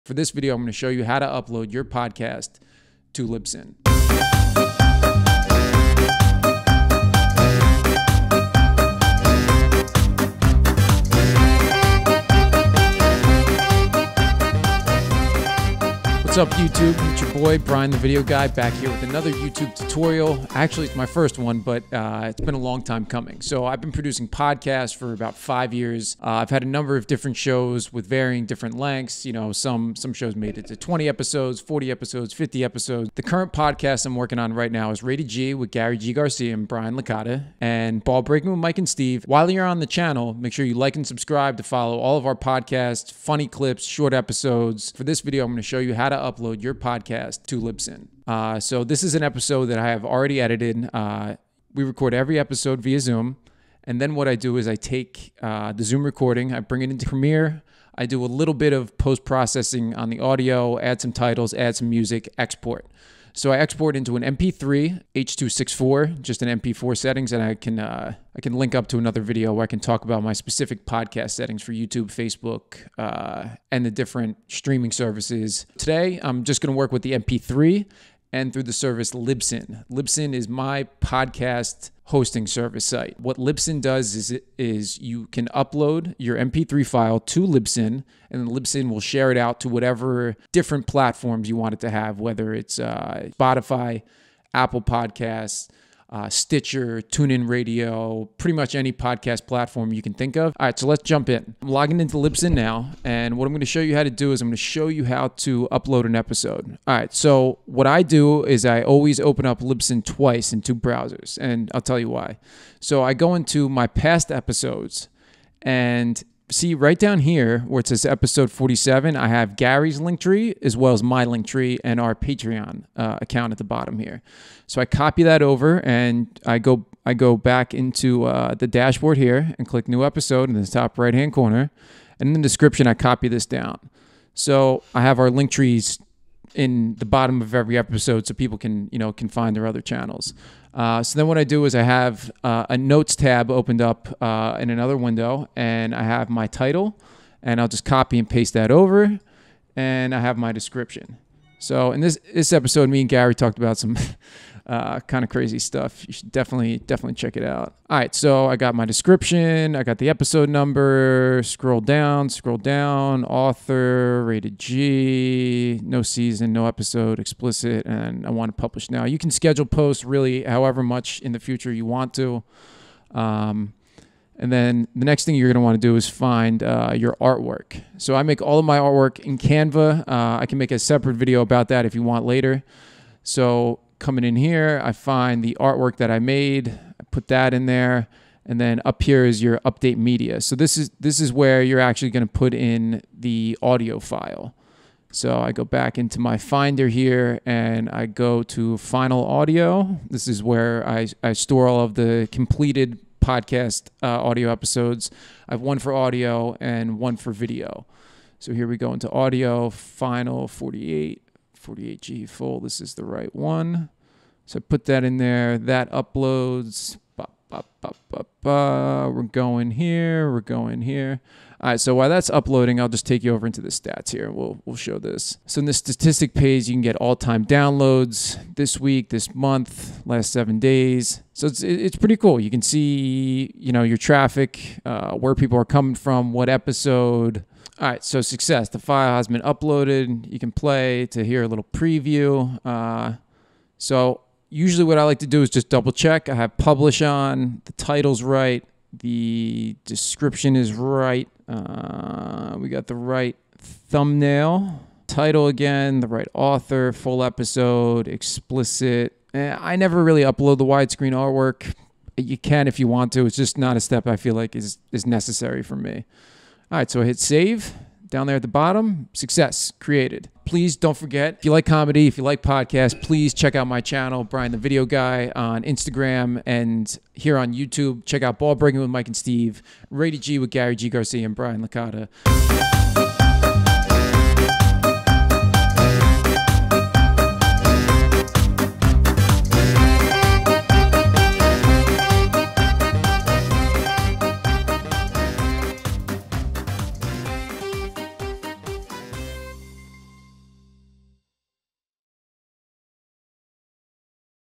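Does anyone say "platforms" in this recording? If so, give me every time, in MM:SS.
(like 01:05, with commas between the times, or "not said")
01:30, 01:39.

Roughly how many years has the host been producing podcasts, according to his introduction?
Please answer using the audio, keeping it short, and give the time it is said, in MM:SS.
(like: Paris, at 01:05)
5 years, at 00:25.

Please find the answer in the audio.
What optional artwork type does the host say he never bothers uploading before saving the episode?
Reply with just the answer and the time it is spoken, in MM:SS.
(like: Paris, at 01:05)
widescreen artwork, at 04:20.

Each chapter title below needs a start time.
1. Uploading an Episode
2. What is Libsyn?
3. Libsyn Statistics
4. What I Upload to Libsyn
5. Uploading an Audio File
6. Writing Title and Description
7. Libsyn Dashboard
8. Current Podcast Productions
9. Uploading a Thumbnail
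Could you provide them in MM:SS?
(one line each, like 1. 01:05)
1. 02:09
2. 01:15
3. 03:43
4. 00:45
5. 03:13
6. 02:27
7. 01:47
8. 00:15
9. 02:56.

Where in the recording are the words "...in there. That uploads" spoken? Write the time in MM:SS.
03:35.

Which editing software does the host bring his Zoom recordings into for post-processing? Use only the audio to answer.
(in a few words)
Premiere.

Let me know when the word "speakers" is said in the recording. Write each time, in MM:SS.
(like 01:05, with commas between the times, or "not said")
not said.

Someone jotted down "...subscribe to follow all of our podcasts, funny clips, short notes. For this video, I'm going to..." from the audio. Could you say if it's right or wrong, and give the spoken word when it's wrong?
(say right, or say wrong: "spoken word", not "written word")
wrong: "episodes", not "notes".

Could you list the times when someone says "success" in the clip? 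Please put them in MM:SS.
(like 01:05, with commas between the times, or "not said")
03:58, 04:29.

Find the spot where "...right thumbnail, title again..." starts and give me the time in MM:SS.
04:12.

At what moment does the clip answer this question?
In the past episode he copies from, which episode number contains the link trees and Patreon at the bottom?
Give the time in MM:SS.
01:58.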